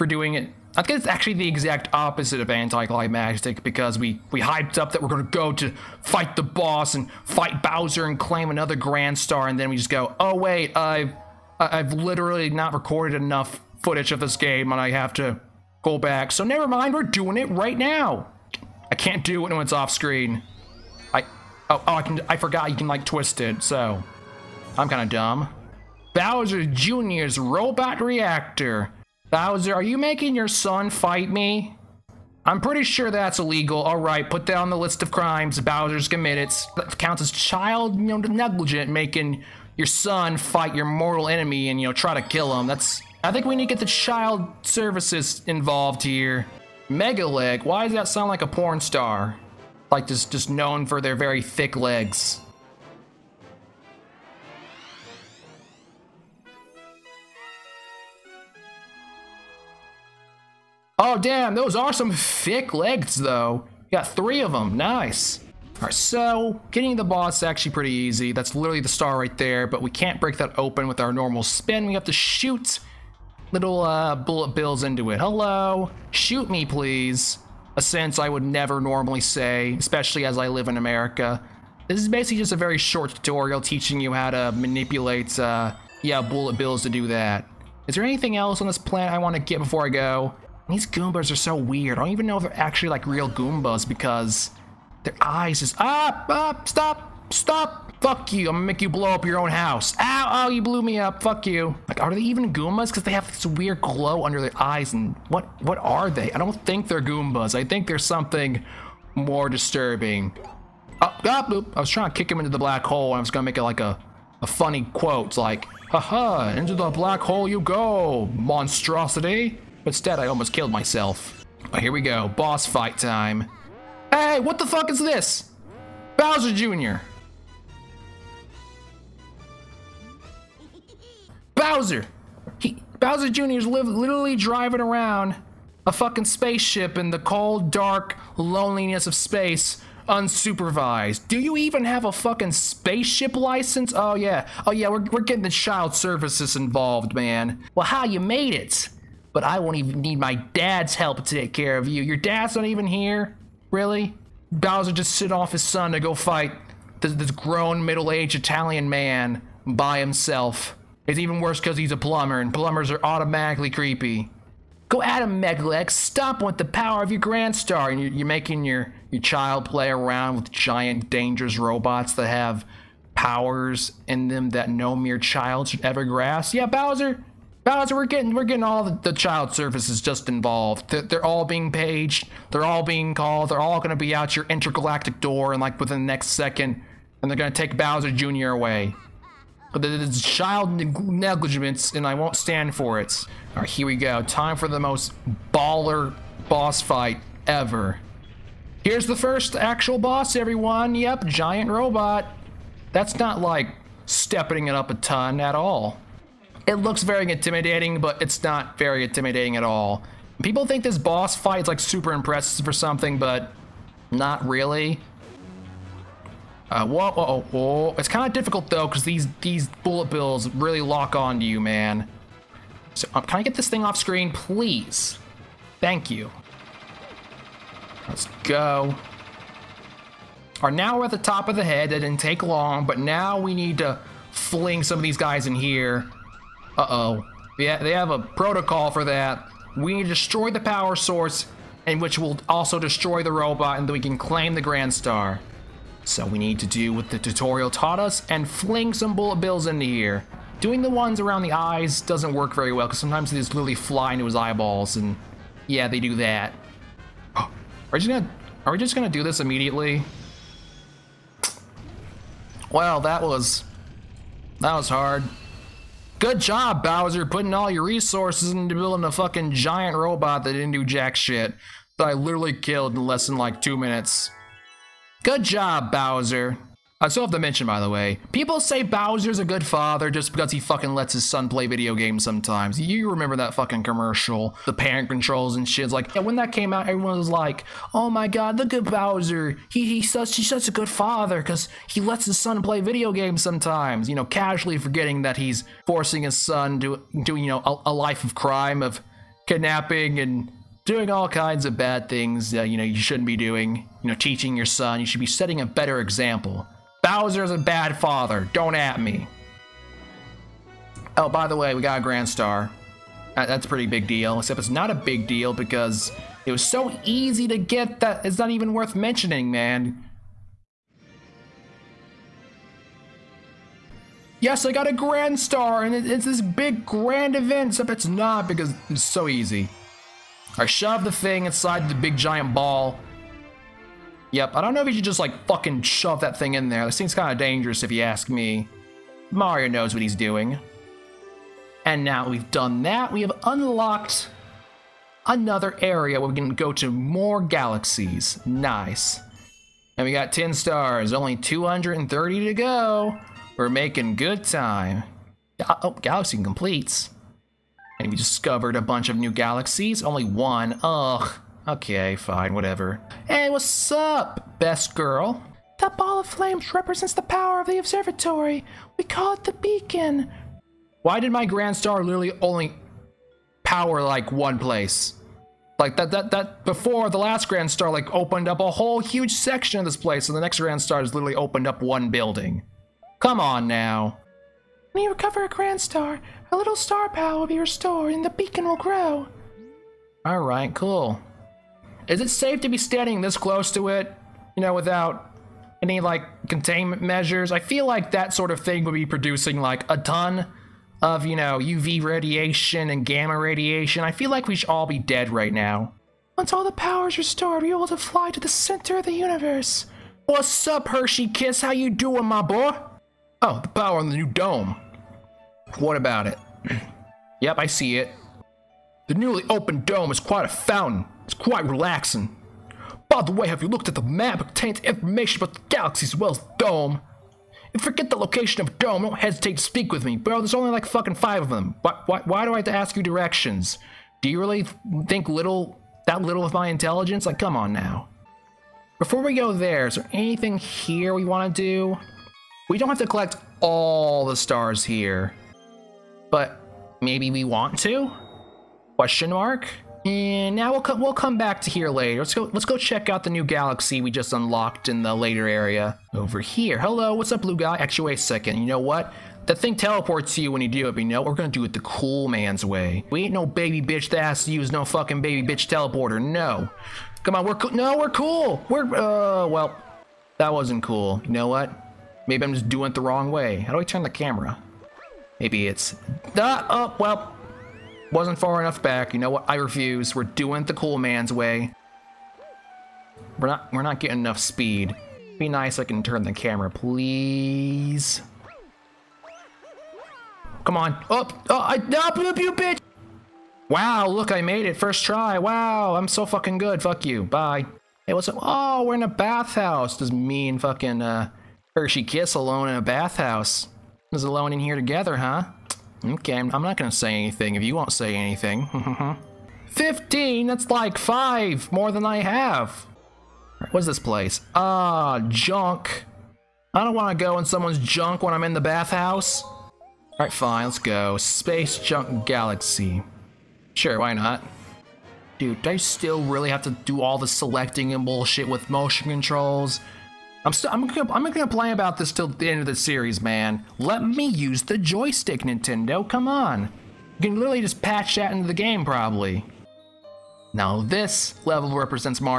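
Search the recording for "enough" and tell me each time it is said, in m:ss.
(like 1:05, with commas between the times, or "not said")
0:13, 7:58, 8:04.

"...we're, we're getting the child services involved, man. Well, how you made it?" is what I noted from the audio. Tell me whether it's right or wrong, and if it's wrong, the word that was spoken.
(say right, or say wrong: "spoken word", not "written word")
right.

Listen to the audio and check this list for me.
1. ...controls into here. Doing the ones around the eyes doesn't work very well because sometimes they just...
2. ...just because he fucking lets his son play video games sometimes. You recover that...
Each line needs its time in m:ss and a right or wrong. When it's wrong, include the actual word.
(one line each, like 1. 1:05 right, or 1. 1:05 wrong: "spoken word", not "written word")
1. 4:09 wrong: "bills", not "controls"
2. 4:40 wrong: "remember", not "recover".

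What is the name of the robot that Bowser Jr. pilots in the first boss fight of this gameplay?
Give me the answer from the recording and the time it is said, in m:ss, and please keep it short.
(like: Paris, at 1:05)
Megaleg, at 2:44.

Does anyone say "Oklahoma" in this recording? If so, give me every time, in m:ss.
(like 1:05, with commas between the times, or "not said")
not said.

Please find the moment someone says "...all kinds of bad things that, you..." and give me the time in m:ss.
5:01.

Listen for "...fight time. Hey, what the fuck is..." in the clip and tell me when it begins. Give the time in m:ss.
2:02.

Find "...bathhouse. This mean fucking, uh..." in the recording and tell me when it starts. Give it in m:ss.
8:19.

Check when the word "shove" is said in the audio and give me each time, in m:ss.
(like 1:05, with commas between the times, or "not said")
5:30, 5:35.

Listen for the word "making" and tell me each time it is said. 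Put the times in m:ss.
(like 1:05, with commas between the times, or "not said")
0:29, 0:38, 2:48, 5:53.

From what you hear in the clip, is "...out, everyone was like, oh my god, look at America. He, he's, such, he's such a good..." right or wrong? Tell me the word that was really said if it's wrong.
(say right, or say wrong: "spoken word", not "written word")
wrong: "Bowser", not "America".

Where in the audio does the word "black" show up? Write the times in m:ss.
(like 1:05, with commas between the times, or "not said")
1:52, 1:56.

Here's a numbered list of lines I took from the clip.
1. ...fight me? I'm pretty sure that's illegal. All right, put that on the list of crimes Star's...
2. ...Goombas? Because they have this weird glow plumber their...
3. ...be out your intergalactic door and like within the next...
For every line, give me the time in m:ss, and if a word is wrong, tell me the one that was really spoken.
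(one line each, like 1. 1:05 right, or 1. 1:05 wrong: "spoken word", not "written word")
1. 0:30 wrong: "Bowser", not "Star"
2. 1:42 wrong: "under", not "plumber"
3. 3:03 right.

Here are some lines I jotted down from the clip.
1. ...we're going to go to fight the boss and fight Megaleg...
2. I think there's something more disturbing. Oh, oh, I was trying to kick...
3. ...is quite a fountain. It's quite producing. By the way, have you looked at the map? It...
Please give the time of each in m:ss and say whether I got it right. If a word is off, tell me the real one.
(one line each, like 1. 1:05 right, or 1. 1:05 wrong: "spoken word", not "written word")
1. 0:05 wrong: "Bowser", not "Megaleg"
2. 1:47 right
3. 7:00 wrong: "relaxing", not "producing".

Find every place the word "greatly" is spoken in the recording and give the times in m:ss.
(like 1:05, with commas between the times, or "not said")
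not said.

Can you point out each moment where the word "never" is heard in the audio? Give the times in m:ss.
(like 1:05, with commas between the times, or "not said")
0:16, 1:18.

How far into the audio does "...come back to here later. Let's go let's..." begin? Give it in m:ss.
7:31.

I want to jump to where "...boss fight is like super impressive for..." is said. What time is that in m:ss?
3:30.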